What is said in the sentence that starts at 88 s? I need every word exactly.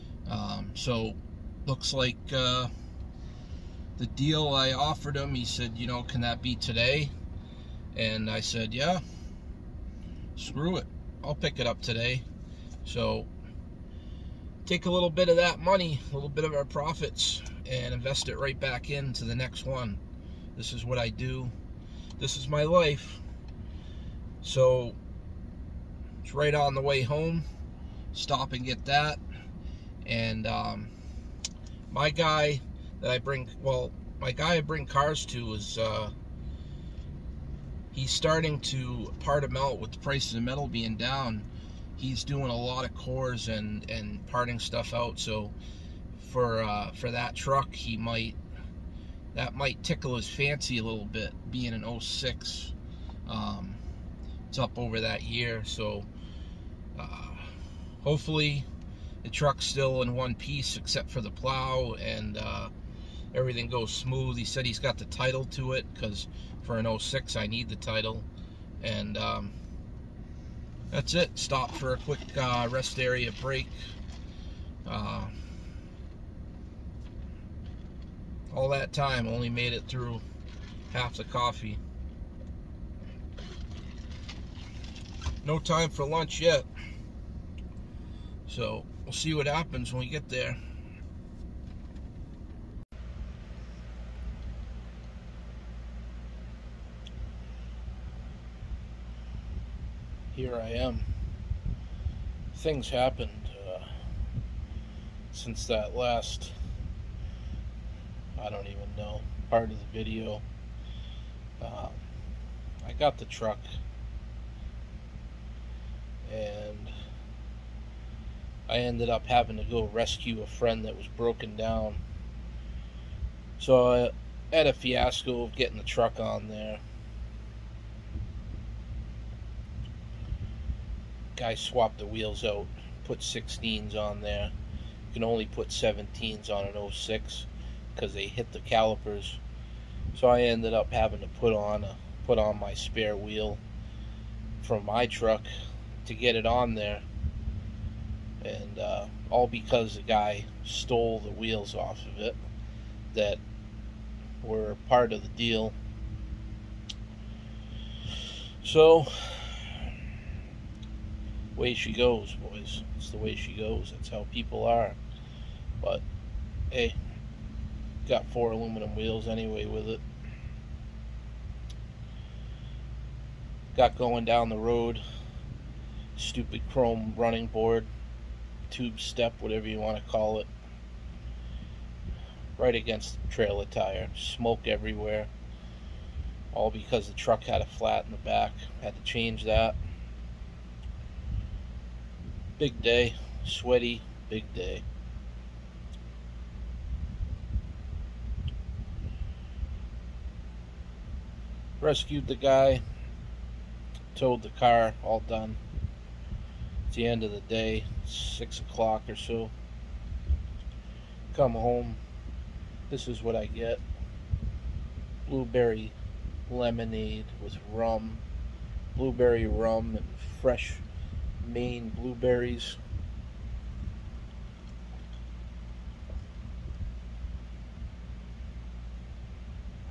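So We'll see what happens when we get there.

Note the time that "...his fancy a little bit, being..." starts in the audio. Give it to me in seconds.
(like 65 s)
50 s.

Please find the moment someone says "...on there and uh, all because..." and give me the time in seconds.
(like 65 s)
146 s.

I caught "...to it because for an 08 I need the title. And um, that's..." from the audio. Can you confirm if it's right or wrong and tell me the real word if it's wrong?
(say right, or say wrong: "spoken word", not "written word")
wrong: "06", not "08".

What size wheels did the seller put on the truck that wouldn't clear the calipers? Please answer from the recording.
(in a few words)
16.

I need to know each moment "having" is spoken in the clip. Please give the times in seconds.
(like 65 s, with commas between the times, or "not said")
119 s, 140 s.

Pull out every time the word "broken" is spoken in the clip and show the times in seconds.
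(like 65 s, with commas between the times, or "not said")
121 s.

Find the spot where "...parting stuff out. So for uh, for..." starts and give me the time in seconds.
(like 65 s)
44 s.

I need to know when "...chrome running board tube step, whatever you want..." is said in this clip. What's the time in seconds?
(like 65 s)
176 s.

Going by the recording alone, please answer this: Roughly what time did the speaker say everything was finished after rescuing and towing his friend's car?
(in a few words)
6 o'clock.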